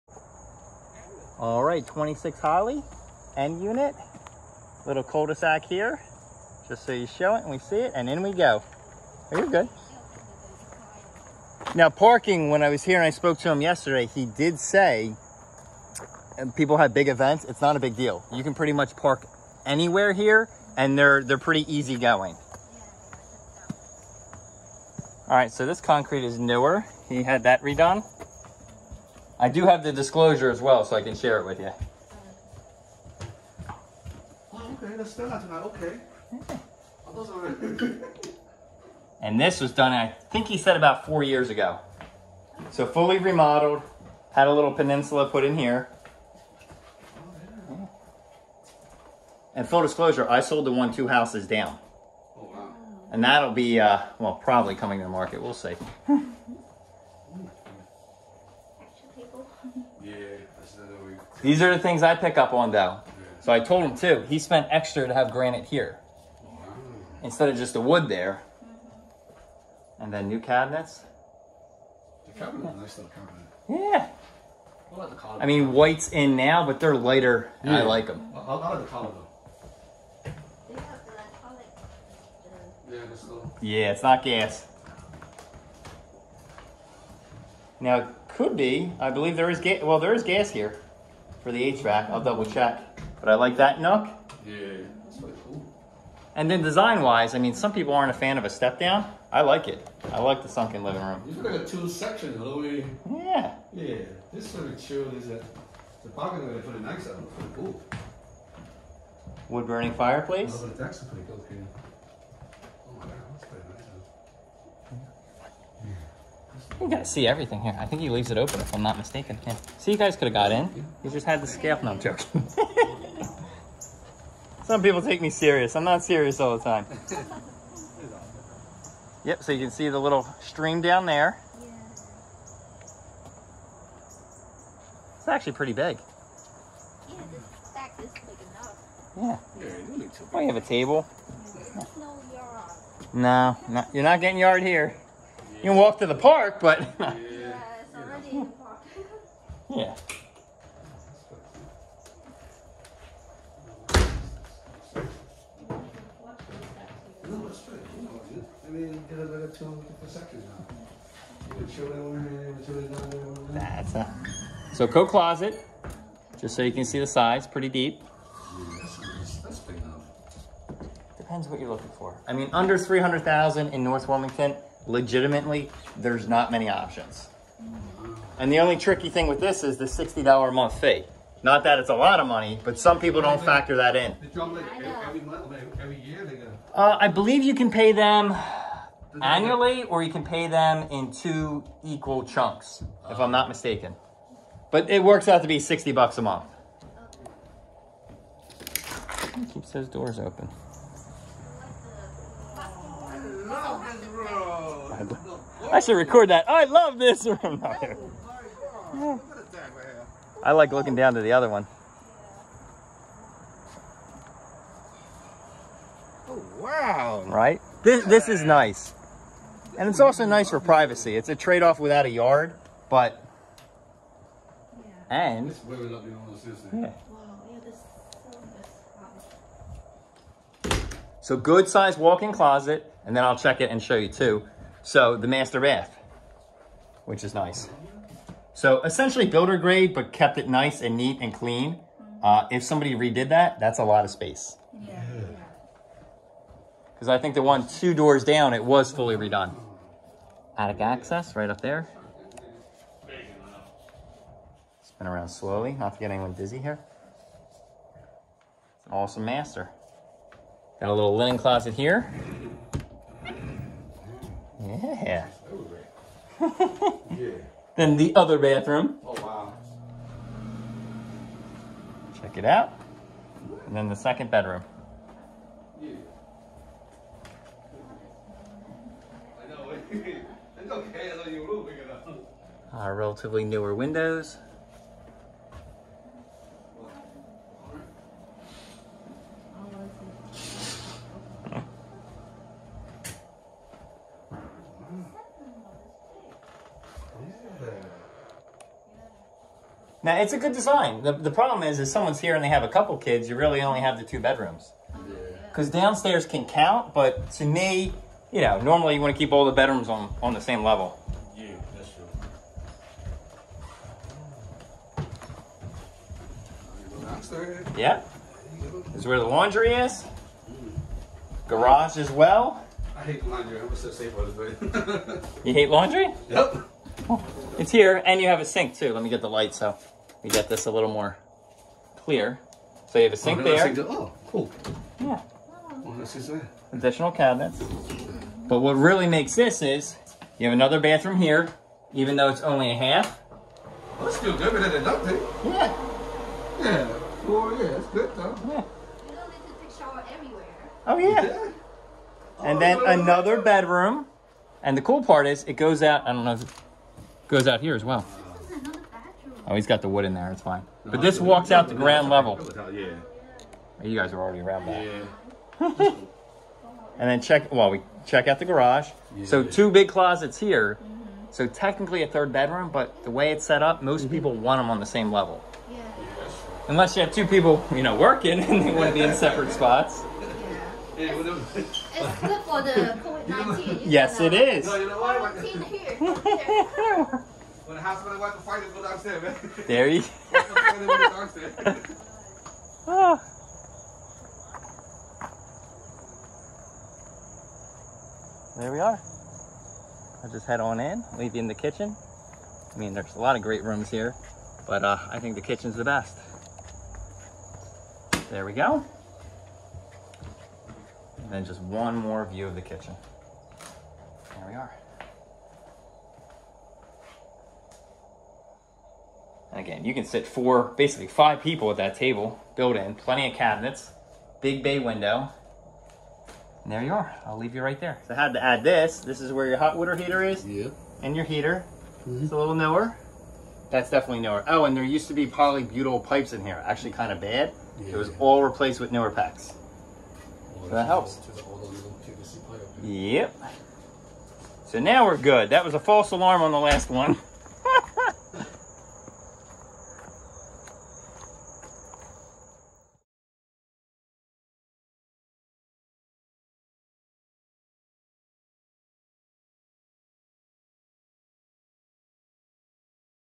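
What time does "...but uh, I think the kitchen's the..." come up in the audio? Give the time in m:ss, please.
6:44.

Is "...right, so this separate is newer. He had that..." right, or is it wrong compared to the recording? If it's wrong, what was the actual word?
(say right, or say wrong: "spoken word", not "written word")
wrong: "concrete", not "separate".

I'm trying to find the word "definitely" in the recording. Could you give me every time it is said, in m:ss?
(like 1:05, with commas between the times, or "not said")
7:13.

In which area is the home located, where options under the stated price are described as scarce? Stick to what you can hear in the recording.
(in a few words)
North Wilmington.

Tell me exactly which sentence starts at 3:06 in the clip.
Uh, I believe you can pay them annually or you can pay them in two equal chunks, if I'm not mistaken.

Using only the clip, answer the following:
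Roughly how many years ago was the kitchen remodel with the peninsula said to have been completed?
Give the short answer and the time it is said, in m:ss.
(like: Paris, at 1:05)
4 years, at 0:40.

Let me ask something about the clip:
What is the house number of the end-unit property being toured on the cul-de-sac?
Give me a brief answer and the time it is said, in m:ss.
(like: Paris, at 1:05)
26, at 0:01.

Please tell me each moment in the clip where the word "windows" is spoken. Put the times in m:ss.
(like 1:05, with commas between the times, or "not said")
4:43, 7:04.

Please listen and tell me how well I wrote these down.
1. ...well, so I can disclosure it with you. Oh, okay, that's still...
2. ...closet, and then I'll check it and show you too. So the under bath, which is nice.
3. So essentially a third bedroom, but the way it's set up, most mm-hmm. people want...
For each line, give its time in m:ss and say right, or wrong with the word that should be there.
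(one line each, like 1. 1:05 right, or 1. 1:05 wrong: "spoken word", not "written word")
1. 0:30 wrong: "share", not "disclosure"
2. 3:52 wrong: "master", not "under"
3. 6:11 wrong: "technically", not "essentially".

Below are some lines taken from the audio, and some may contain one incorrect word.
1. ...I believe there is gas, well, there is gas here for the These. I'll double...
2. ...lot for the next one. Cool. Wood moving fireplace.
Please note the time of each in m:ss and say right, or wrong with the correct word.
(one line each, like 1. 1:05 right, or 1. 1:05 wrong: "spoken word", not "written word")
1. 1:28 wrong: "HVAC", not "These"
2. 1:46 wrong: "burning", not "moving".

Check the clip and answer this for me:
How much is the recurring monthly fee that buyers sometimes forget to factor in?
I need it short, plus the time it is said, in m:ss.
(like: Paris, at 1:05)
$60, at 2:59.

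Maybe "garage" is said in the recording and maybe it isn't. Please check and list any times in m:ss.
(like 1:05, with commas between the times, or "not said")
5:21, 6:08.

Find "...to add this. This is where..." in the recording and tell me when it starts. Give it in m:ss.
7:08.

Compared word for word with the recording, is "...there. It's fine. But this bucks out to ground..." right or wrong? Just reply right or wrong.
wrong.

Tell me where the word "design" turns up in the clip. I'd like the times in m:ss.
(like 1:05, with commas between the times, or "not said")
1:36, 5:00.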